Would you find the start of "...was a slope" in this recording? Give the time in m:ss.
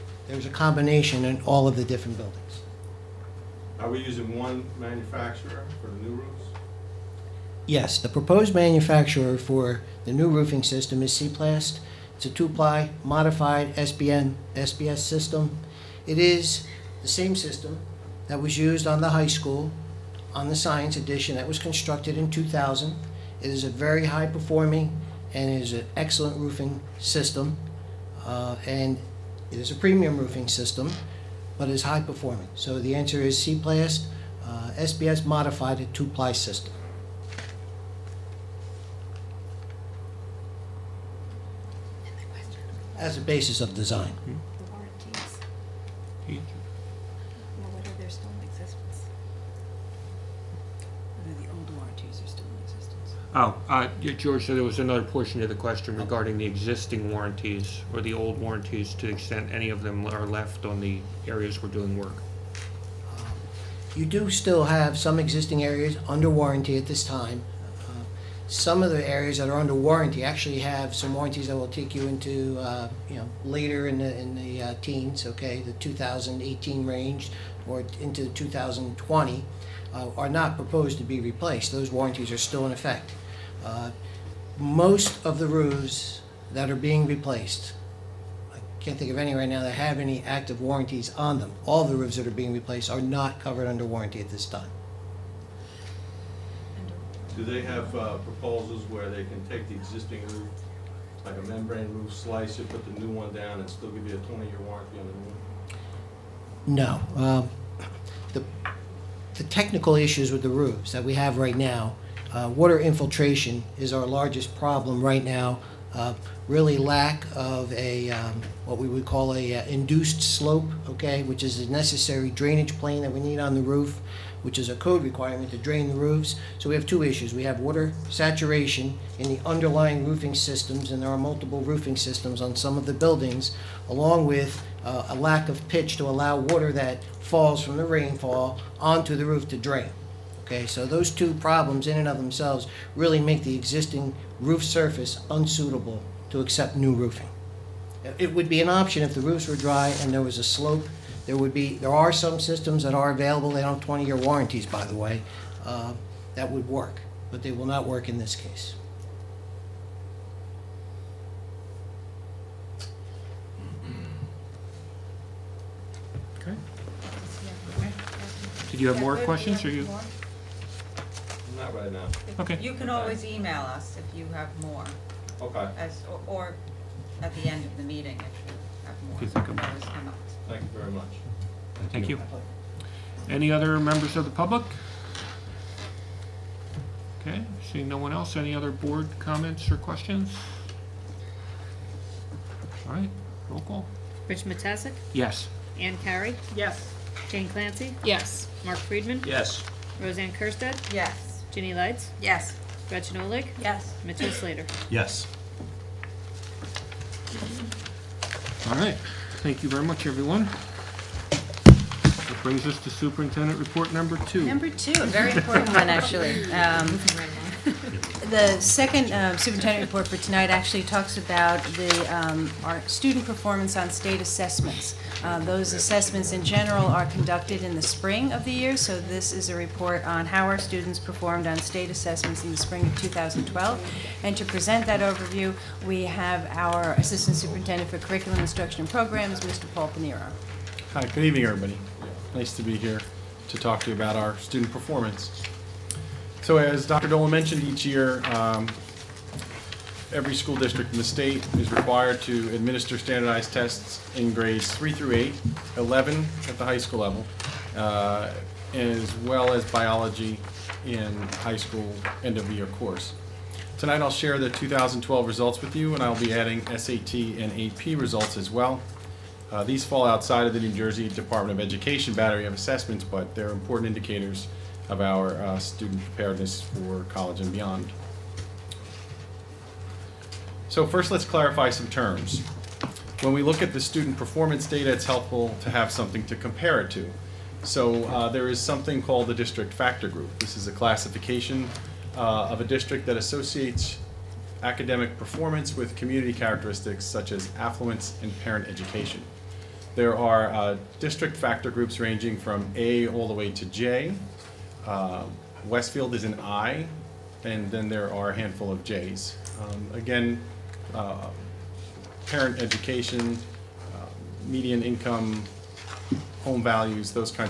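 2:30.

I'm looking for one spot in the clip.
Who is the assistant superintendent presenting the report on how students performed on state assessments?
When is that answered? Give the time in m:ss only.
3:59.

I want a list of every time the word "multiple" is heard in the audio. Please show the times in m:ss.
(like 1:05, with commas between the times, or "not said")
2:11.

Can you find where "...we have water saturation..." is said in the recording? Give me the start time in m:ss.
2:07.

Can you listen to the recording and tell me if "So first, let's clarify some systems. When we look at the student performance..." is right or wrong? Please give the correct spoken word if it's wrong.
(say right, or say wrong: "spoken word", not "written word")
wrong: "terms", not "systems".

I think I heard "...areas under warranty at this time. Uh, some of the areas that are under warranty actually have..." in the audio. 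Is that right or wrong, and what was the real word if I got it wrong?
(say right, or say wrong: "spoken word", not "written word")
right.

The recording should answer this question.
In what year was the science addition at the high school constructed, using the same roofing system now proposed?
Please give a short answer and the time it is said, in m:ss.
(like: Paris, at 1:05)
2000, at 0:22.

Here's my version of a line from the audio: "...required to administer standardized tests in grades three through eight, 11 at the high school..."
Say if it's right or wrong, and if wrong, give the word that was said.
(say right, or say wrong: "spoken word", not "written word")
right.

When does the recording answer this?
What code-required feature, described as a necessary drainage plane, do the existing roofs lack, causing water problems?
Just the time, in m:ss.
1:59.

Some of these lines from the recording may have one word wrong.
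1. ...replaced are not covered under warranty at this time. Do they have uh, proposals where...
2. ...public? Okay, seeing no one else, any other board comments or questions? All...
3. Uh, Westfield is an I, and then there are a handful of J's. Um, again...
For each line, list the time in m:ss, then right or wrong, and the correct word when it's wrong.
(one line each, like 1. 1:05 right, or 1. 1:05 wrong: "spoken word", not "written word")
1. 1:32 right
2. 3:04 right
3. 5:04 right.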